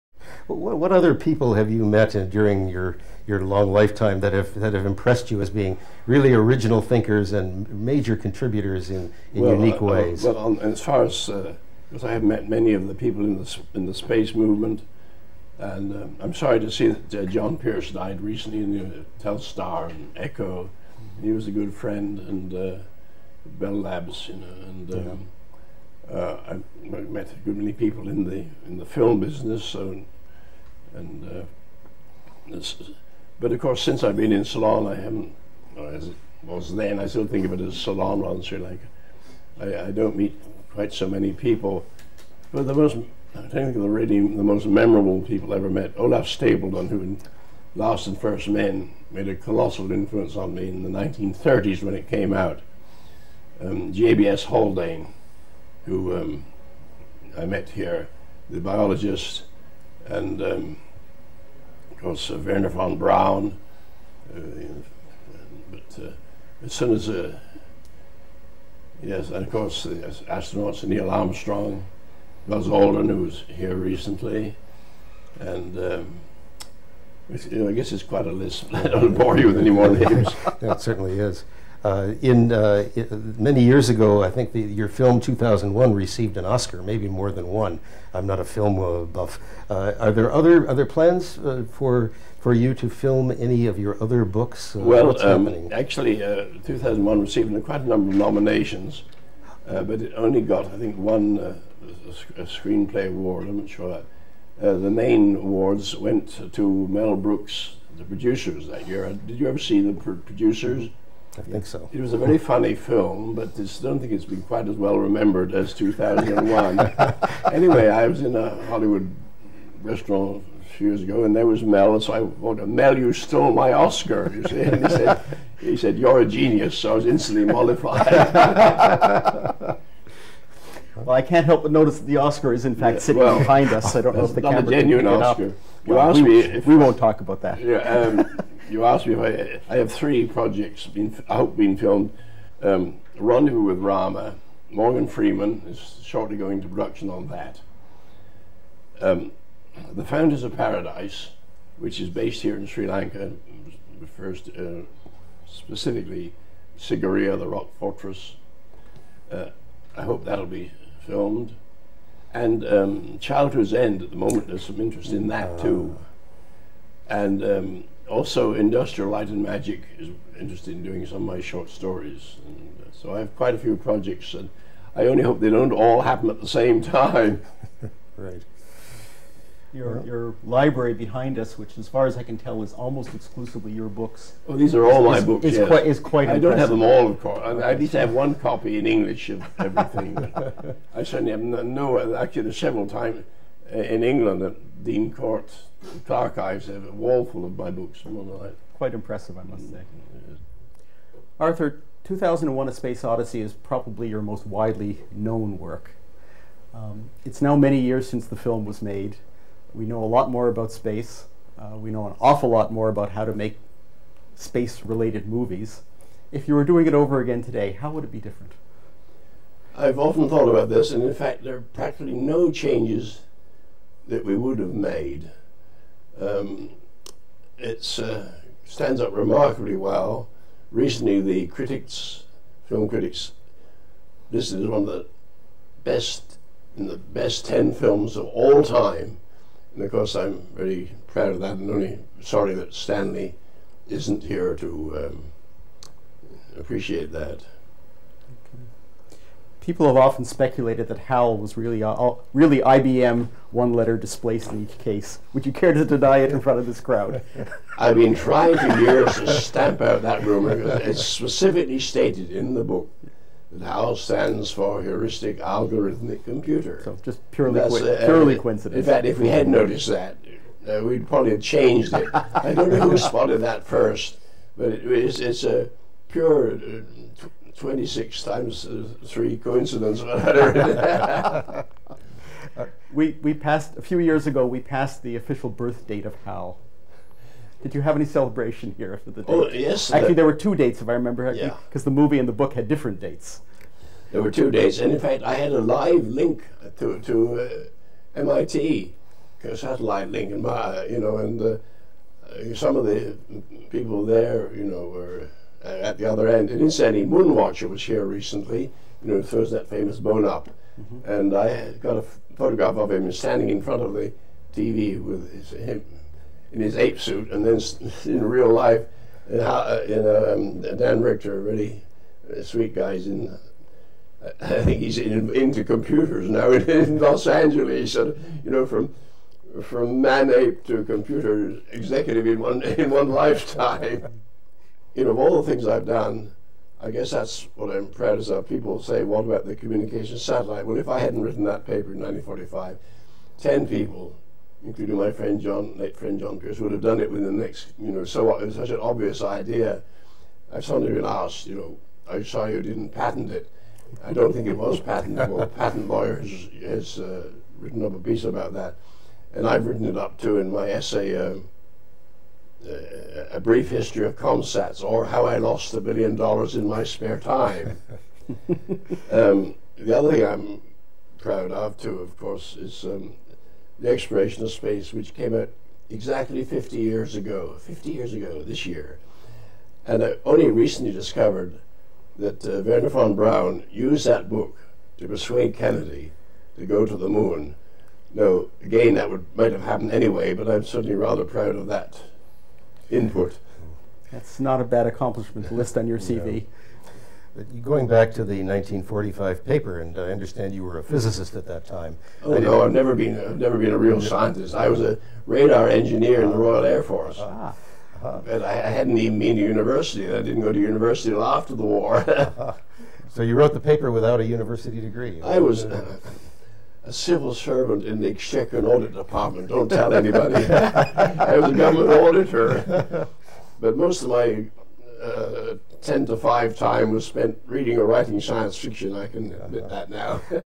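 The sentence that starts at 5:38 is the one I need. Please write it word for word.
People say, what about the communication satellite?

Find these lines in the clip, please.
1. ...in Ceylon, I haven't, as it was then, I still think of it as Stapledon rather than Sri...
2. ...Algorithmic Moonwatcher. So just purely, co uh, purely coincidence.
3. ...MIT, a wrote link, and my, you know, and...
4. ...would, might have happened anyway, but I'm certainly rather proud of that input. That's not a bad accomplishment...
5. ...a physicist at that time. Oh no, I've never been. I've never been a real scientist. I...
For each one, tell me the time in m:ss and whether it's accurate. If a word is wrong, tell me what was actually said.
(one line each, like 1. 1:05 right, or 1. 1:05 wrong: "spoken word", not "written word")
1. 0:34 wrong: "Ceylon", not "Stapledon"
2. 4:25 wrong: "Computer", not "Moonwatcher"
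3. 4:58 wrong: "satellite", not "wrote"
4. 6:29 right
5. 6:40 right.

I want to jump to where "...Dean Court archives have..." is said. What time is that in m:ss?
3:14.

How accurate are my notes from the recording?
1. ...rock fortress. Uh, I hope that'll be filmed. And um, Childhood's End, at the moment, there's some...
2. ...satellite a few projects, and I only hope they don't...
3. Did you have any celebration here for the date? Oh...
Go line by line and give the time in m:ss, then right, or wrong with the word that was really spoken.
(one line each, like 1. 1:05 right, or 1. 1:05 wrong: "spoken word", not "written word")
1. 2:37 right
2. 2:53 wrong: "quite", not "satellite"
3. 4:47 right.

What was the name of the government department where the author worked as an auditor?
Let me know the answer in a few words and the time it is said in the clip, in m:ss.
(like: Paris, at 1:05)
Exchequer and Audit Department, at 6:58.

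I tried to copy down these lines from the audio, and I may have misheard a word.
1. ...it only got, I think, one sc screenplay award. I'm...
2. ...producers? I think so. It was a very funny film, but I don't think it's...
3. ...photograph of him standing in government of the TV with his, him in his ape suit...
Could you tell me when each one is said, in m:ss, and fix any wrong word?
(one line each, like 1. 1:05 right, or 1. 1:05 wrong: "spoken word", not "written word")
1. 1:40 right
2. 1:50 right
3. 5:12 wrong: "front", not "government".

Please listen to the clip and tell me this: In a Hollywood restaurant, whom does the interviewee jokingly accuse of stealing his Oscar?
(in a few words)
Mel Brooks.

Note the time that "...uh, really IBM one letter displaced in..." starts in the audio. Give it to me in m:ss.
4:11.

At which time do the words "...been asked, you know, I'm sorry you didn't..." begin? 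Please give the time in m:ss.
5:50.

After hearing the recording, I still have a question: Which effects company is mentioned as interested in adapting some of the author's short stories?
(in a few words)
Industrial Light and Magic.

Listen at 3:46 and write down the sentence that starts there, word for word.
Um, it uh, stands up remarkably well.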